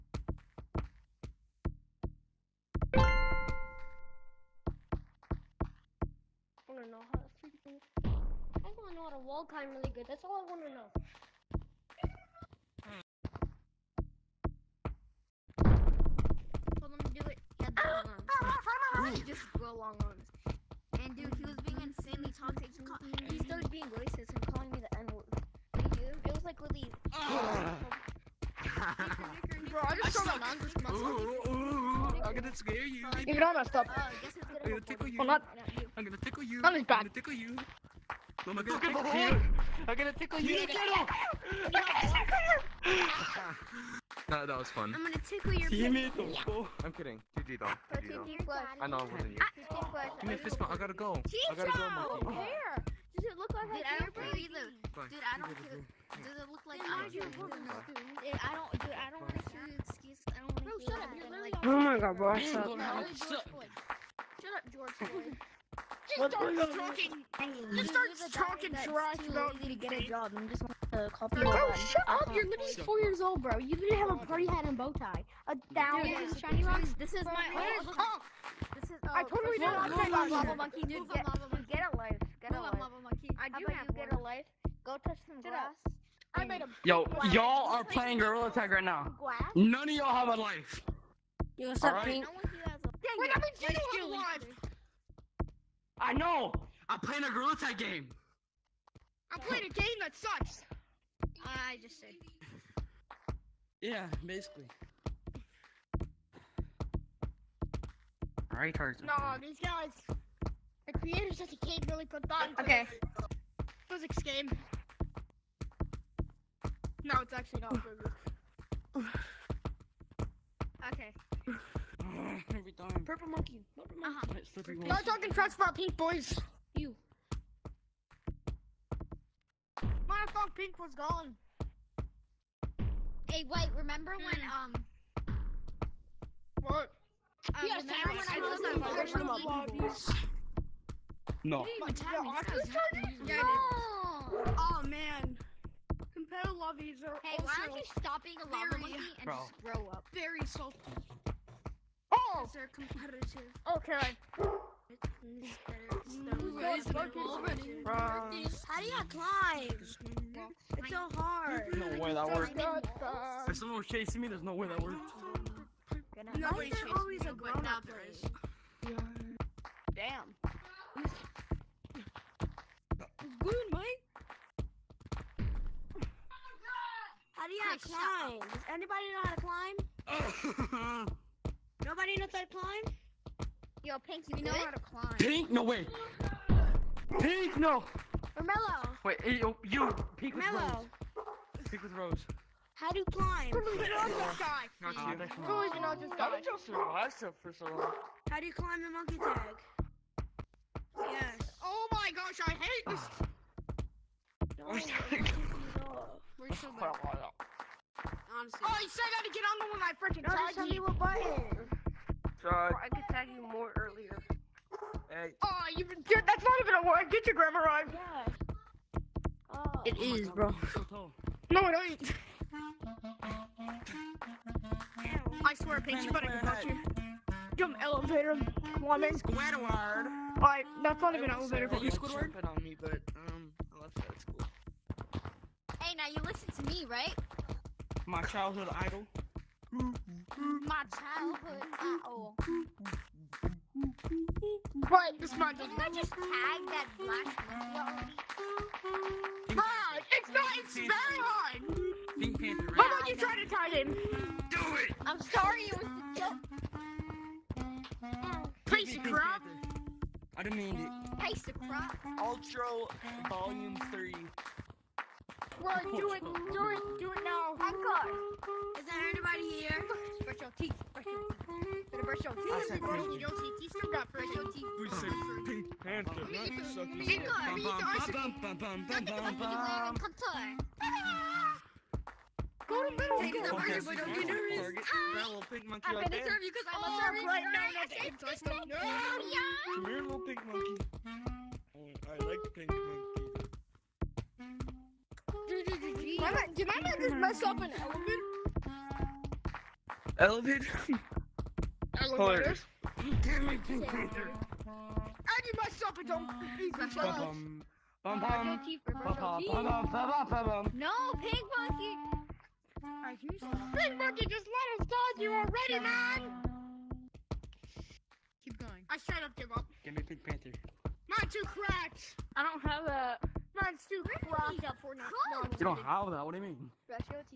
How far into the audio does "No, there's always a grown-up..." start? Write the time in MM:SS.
02:46.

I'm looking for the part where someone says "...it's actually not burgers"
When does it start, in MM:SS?
01:57.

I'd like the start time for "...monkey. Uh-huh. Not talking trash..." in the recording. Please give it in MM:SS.
02:04.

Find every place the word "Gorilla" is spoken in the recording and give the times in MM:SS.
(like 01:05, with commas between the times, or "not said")
01:28, 01:37.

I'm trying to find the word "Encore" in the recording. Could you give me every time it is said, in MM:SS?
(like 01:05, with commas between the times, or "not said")
04:27, 04:36.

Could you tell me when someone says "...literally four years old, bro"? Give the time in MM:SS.
01:12.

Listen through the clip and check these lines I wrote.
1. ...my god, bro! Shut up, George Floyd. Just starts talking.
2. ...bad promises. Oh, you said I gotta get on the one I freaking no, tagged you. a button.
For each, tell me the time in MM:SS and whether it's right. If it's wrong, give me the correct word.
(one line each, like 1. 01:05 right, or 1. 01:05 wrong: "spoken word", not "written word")
1. 01:01 right
2. 03:26 right.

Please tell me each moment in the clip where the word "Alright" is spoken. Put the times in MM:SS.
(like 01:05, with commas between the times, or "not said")
01:48, 03:50.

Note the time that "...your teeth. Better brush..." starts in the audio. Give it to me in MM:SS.
04:31.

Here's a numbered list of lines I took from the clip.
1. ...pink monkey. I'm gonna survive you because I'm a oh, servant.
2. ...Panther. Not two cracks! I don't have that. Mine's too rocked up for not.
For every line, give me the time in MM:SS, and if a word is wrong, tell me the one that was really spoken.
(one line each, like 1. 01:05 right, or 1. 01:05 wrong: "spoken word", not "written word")
1. 04:45 wrong: "serve", not "survive"
2. 05:20 right.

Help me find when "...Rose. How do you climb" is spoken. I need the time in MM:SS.
03:11.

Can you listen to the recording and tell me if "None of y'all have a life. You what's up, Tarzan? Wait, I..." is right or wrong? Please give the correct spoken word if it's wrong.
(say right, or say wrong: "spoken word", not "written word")
wrong: "Pink", not "Tarzan".